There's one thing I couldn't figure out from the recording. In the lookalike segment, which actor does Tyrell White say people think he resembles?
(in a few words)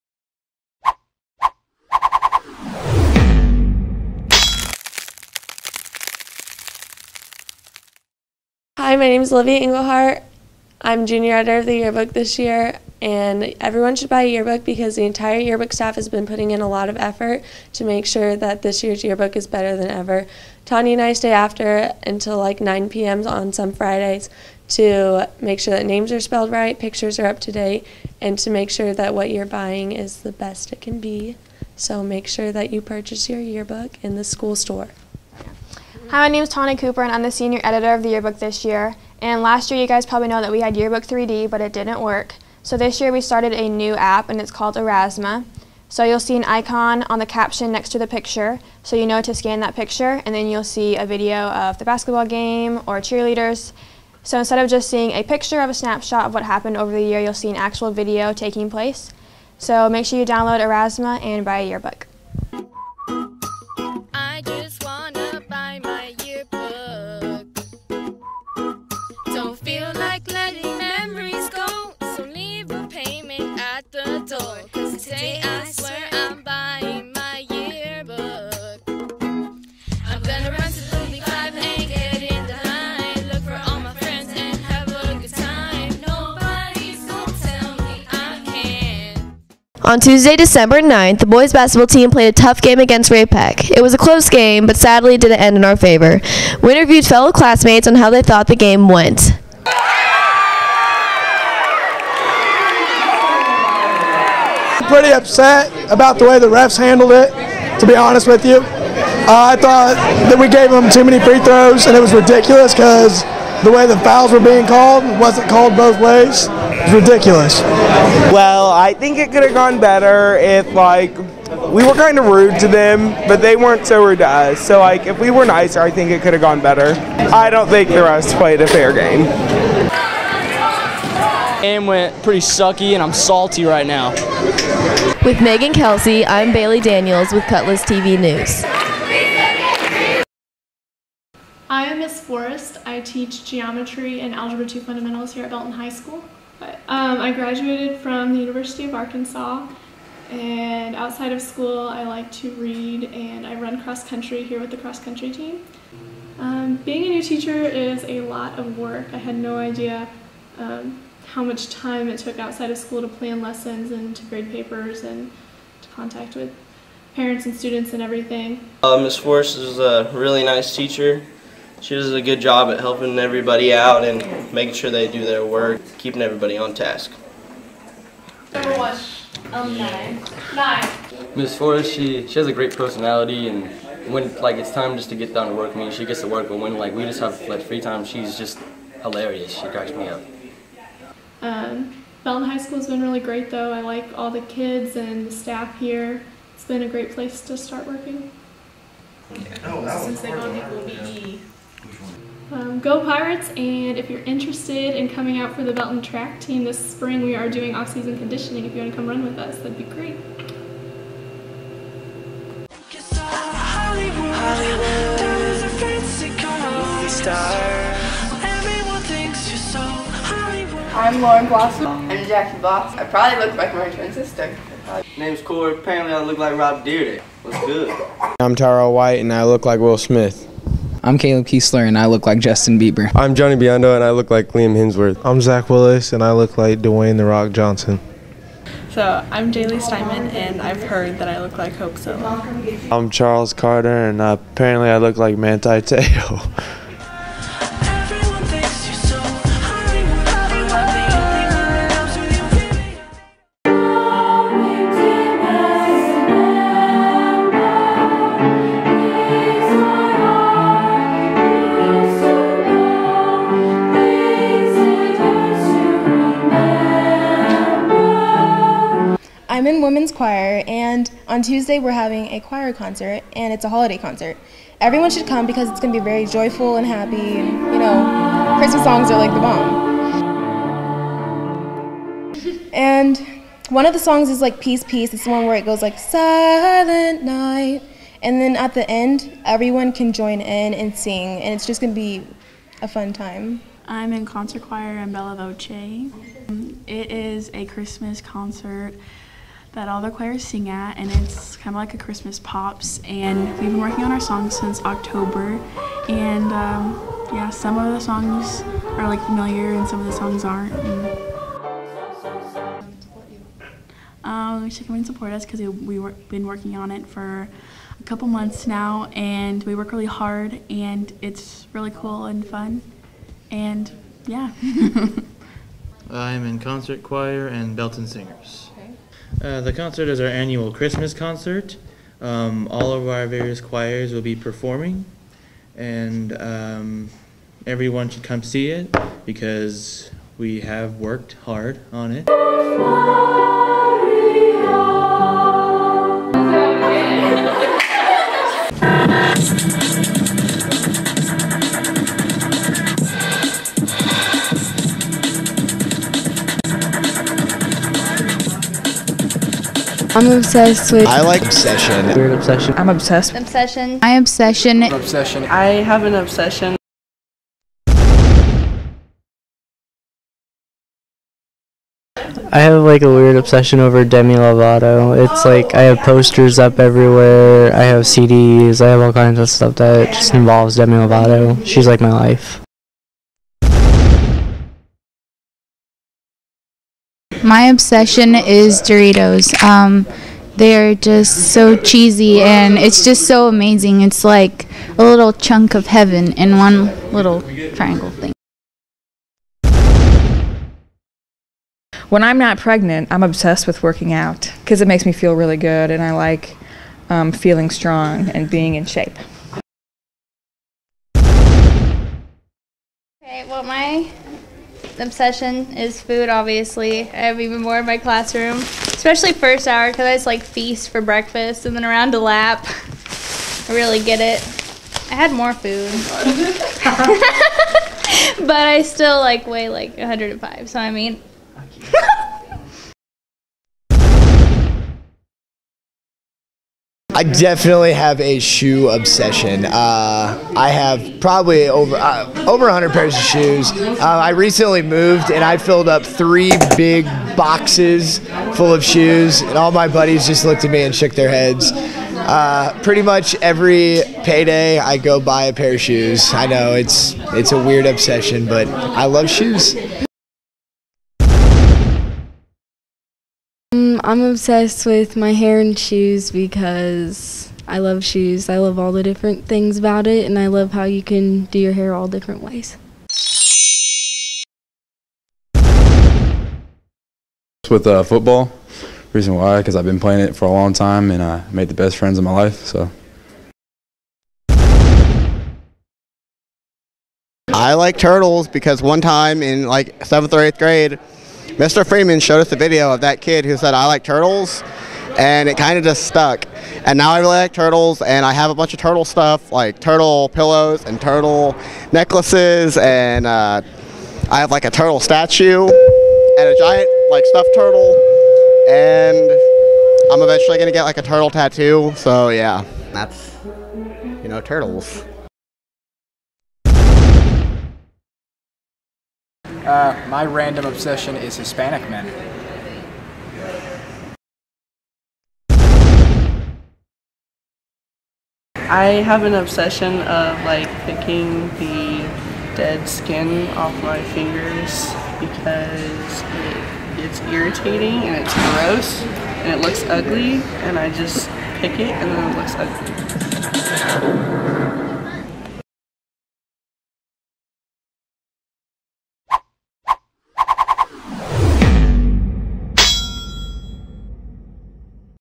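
Will Smith.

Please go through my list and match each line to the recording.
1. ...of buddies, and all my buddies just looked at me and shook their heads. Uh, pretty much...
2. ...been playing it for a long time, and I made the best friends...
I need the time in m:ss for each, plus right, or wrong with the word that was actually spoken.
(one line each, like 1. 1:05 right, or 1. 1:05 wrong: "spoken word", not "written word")
1. 7:28 wrong: "shoes", not "buddies"
2. 7:59 right.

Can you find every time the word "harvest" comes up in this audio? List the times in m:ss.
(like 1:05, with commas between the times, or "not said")
not said.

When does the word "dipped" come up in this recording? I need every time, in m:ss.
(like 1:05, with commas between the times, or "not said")
not said.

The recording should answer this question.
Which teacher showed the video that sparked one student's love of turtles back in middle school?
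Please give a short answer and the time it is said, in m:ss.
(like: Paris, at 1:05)
Mr. Freeman, at 8:11.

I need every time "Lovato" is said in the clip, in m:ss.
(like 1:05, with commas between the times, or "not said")
6:14, 6:20.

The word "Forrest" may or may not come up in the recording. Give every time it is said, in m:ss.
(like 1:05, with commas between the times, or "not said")
2:22, 2:49, 3:01.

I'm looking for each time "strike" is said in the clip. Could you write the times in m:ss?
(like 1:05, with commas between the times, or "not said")
not said.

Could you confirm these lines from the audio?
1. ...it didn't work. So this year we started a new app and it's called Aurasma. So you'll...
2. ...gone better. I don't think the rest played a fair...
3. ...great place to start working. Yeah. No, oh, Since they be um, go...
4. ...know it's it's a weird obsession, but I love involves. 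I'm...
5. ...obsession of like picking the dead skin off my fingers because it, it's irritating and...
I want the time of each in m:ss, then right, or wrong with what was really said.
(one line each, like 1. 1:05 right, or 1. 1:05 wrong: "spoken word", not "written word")
1. 0:41 right
2. 2:06 right
3. 3:16 right
4. 7:36 wrong: "shoes", not "involves"
5. 8:49 right.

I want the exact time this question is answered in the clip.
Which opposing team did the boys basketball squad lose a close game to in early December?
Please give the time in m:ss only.
1:33.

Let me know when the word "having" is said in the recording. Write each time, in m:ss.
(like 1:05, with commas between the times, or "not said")
4:31.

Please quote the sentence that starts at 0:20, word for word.
Tanya and I stay after until like 9 p.m.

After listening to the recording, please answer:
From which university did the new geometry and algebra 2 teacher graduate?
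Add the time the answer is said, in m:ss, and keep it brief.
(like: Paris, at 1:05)
University of Arkansas, at 2:28.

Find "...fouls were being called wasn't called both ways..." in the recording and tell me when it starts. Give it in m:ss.
1:53.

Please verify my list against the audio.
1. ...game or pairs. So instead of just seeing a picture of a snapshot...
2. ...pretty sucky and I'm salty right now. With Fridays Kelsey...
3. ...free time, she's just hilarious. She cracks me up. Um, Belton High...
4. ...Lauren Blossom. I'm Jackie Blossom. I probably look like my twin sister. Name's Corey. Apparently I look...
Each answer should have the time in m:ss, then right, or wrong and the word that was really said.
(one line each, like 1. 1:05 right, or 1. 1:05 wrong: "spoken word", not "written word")
1. 0:52 wrong: "cheerleaders", not "pairs"
2. 2:12 wrong: "Megan", not "Fridays"
3. 3:07 right
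4. 3:41 right.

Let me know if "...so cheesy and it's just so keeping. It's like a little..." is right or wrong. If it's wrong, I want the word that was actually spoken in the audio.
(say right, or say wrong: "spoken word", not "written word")
wrong: "amazing", not "keeping".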